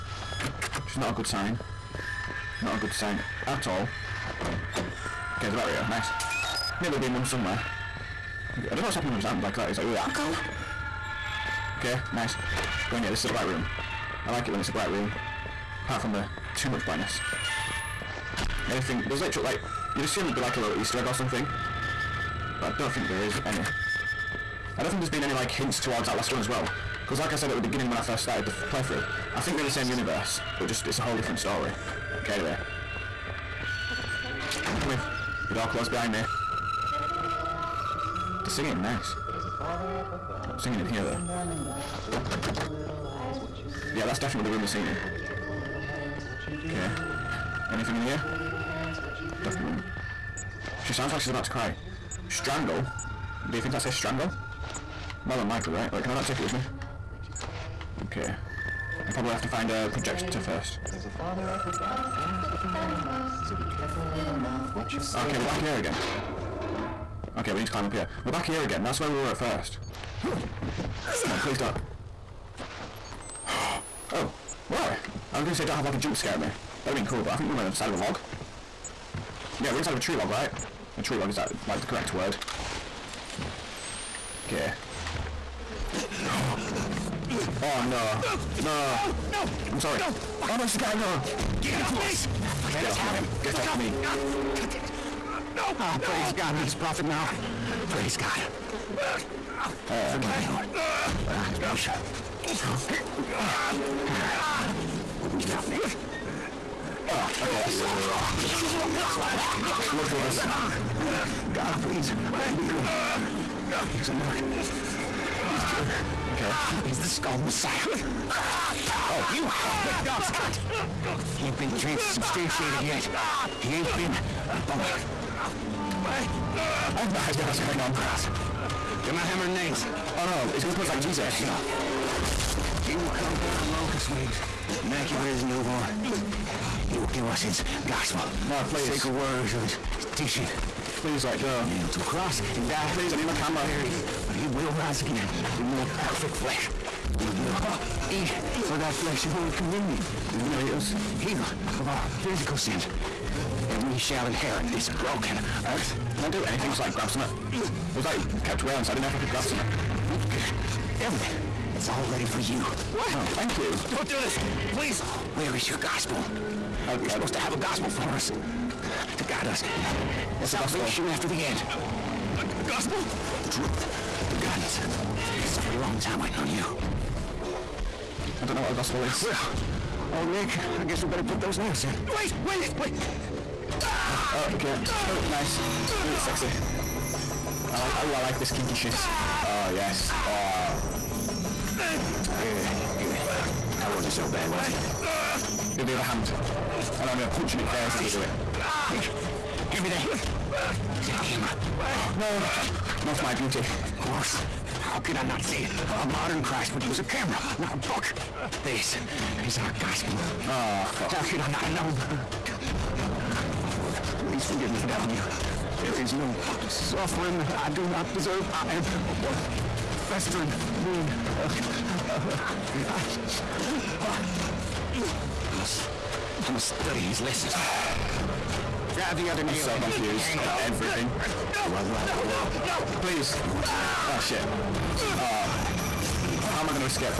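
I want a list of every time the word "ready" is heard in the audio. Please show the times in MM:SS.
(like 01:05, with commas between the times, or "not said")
02:42.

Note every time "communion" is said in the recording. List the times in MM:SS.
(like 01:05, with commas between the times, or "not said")
02:29.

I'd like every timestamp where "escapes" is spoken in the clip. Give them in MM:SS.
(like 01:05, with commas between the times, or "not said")
not said.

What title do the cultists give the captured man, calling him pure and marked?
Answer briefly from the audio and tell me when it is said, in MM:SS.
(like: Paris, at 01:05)
The Skull Messiah, at 01:56.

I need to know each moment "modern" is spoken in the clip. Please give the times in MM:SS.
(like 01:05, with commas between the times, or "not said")
03:26.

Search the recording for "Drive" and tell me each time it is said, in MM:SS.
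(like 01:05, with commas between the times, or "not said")
03:48.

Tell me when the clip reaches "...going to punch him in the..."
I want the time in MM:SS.
03:17.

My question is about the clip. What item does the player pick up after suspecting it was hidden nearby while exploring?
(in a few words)
Battery.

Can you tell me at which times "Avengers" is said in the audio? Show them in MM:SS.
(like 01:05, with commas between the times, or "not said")
not said.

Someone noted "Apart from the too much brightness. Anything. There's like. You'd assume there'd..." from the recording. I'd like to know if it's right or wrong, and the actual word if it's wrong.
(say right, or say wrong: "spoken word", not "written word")
right.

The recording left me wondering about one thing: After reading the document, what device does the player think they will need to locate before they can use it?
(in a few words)
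Projector.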